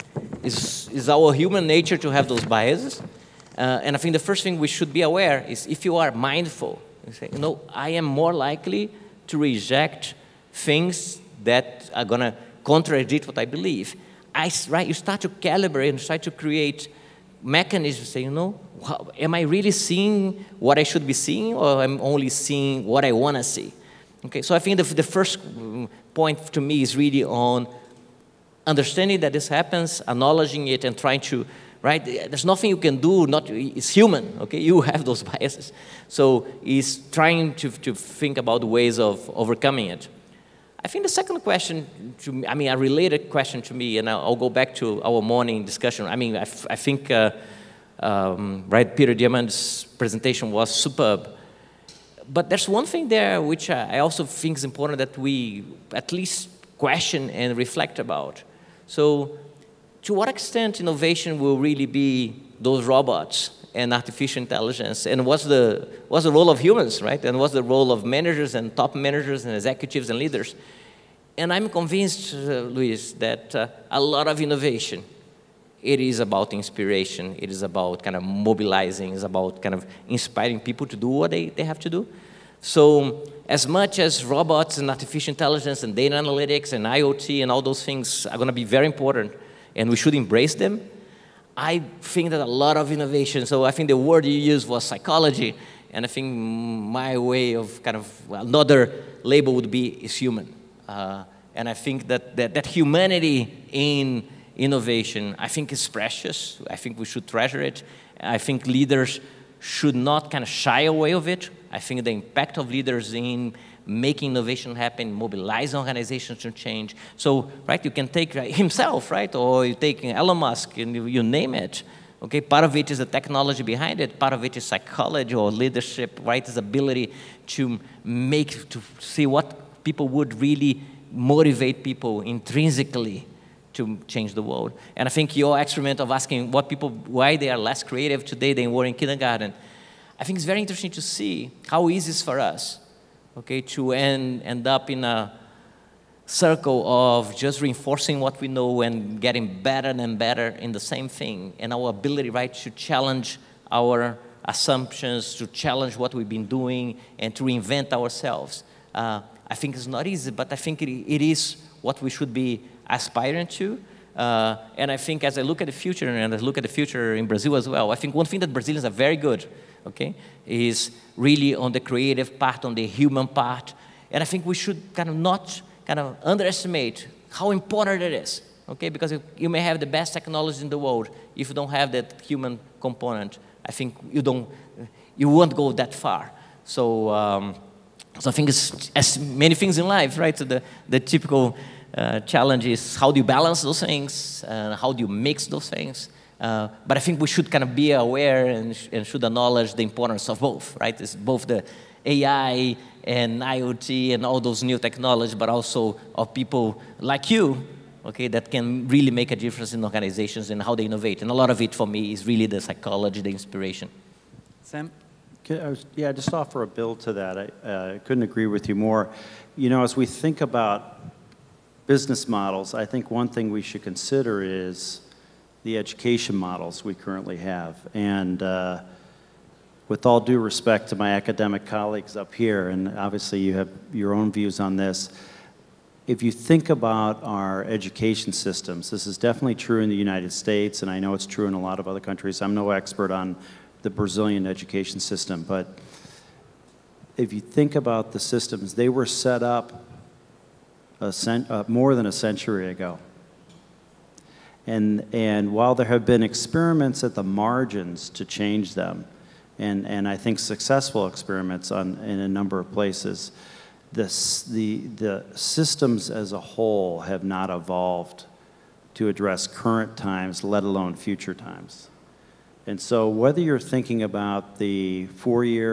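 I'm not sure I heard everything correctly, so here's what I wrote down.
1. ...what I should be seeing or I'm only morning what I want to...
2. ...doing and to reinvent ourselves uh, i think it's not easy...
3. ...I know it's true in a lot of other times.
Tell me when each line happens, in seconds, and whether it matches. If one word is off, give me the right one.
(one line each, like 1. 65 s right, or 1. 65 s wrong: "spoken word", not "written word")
1. 20 s wrong: "seeing", not "morning"
2. 156 s right
3. 240 s wrong: "countries", not "times".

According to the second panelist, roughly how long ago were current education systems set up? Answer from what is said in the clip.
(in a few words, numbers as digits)
more than a century ago.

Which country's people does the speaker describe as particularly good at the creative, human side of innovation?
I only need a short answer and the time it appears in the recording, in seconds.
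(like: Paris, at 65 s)
Brazil, at 167 s.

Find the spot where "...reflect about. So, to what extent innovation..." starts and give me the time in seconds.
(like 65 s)
57 s.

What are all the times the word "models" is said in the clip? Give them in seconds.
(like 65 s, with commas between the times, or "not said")
222 s, 226 s.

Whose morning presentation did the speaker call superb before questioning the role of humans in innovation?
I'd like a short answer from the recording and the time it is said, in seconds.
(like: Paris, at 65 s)
Peter Diamandis, at 48 s.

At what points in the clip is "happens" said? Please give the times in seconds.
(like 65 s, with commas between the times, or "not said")
29 s, 114 s.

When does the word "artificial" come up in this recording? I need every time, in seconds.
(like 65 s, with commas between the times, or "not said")
63 s, 84 s.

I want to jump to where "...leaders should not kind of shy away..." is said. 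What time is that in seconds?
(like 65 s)
108 s.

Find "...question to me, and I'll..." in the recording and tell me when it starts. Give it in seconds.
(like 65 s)
43 s.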